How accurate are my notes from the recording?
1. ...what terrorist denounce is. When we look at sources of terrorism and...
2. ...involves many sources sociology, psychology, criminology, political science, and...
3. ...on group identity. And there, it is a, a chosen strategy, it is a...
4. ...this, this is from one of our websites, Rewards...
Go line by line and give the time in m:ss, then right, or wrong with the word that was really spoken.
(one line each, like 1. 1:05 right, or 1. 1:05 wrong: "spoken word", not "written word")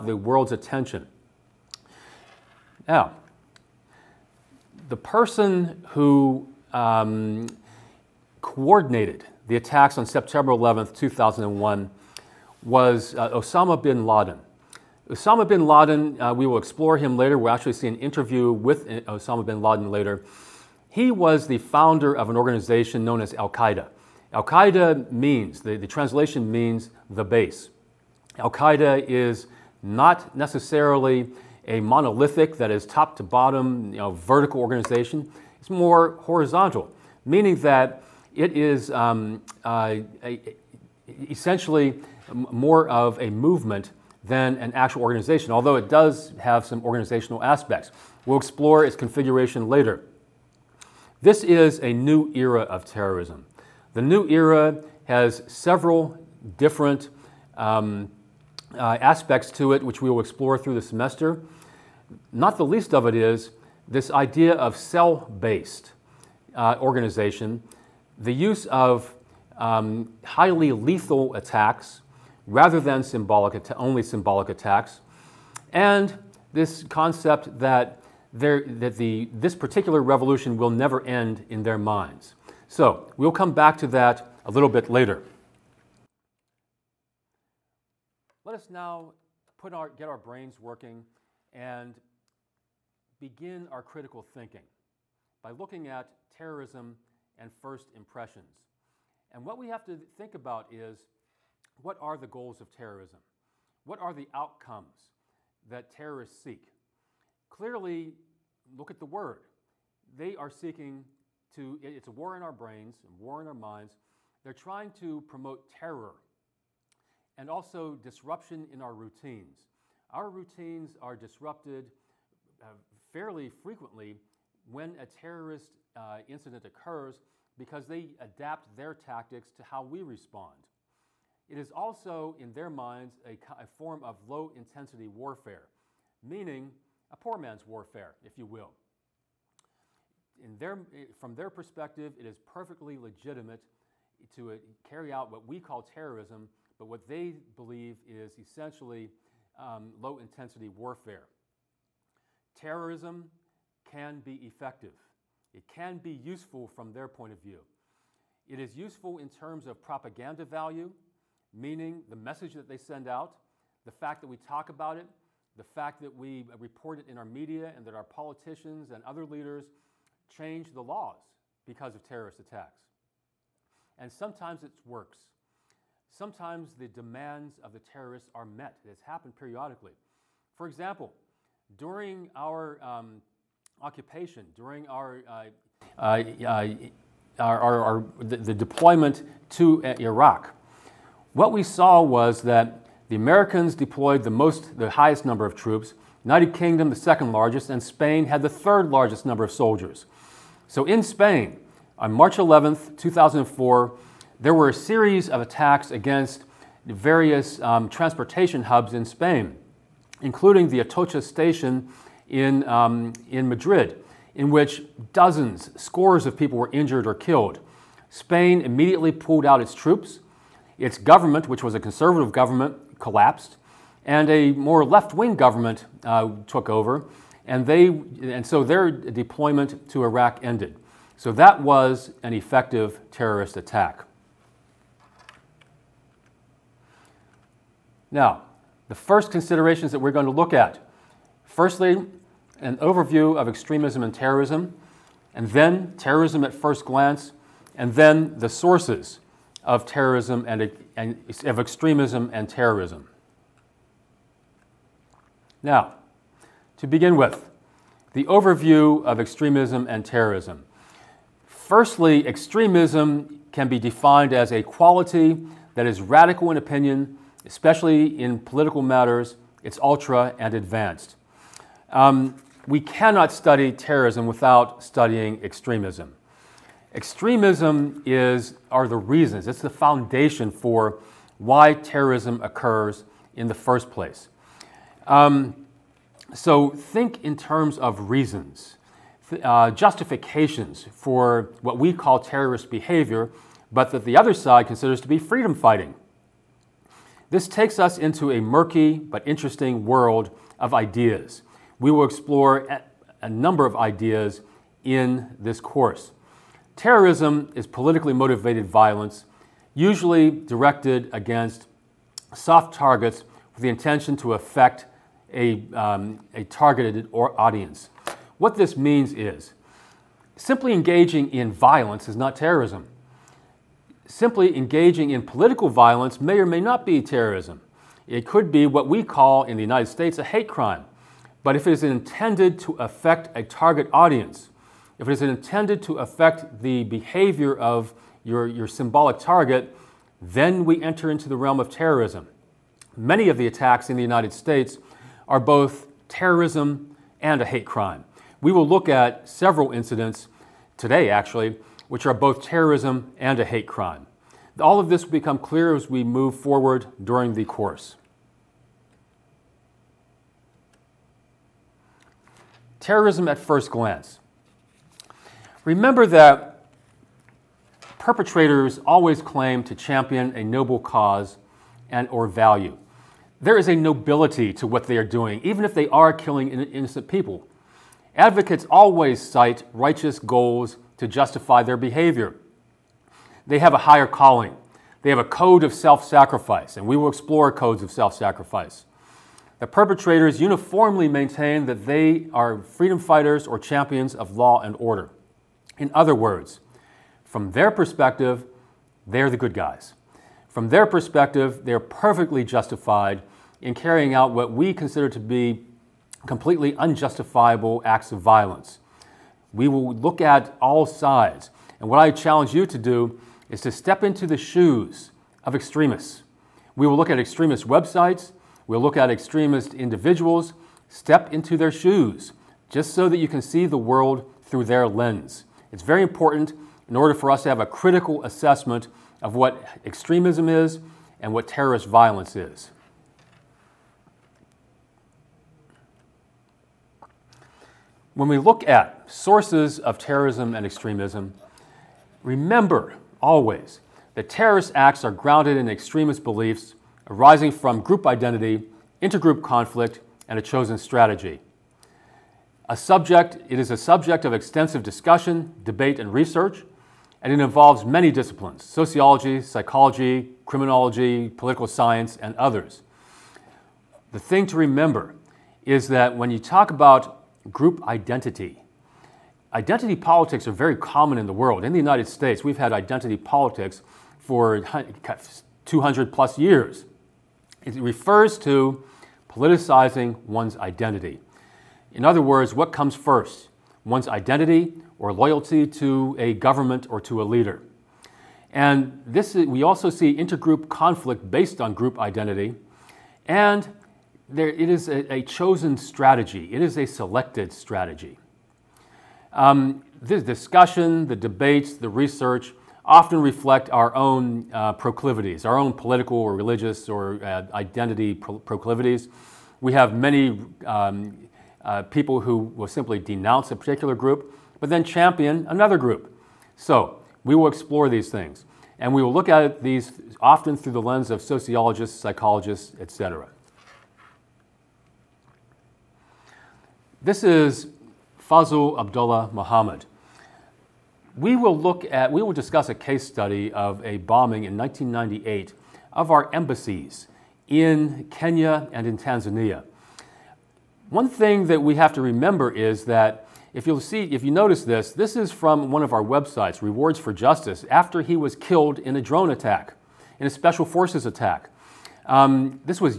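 1. 7:11 wrong: "violence", not "denounce"
2. 7:37 wrong: "disciplines", not "sources"
3. 8:11 right
4. 9:04 right.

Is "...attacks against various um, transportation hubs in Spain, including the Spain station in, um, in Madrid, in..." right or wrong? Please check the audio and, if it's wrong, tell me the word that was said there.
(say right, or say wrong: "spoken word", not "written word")
wrong: "Atocha", not "Spain".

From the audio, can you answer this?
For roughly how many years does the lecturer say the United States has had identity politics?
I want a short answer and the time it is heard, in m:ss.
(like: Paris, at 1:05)
200 plus years, at 7:55.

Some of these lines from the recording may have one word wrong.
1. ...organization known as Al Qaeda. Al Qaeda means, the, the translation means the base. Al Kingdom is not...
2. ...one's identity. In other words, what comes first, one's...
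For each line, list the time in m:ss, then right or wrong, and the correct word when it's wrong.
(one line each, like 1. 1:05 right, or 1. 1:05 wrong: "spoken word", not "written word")
1. 0:22 wrong: "Qaeda", not "Kingdom"
2. 8:00 right.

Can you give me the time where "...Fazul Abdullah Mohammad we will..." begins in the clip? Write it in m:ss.
8:48.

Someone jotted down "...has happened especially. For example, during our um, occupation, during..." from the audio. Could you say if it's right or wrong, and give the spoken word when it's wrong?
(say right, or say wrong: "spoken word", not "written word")
wrong: "periodically", not "especially".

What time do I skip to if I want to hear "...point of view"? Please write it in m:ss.
2:37.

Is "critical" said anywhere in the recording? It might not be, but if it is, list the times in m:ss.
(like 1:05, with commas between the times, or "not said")
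1:33, 7:07.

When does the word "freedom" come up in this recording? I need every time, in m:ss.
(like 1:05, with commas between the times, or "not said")
4:55, 6:32.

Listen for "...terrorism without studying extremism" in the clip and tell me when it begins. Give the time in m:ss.
4:33.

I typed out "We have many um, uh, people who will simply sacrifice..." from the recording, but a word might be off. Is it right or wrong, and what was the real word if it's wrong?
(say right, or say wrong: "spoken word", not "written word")
wrong: "denounce", not "sacrifice".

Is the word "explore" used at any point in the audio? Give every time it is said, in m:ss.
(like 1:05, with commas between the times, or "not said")
0:16, 0:48, 1:00, 5:02, 6:27, 8:37.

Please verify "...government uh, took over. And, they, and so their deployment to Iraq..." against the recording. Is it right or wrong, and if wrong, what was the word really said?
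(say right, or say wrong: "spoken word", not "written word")
right.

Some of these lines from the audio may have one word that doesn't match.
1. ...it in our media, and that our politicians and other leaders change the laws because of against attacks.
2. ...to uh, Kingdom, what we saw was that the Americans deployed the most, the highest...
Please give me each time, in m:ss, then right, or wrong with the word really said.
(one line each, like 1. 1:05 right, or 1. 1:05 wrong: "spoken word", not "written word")
1. 2:46 wrong: "terrorist", not "against"
2. 3:09 wrong: "Iraq", not "Kingdom".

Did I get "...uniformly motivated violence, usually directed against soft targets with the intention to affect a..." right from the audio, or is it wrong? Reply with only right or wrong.
wrong.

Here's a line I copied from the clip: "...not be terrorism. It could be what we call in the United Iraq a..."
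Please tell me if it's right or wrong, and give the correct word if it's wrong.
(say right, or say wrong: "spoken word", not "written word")
wrong: "States", not "Iraq".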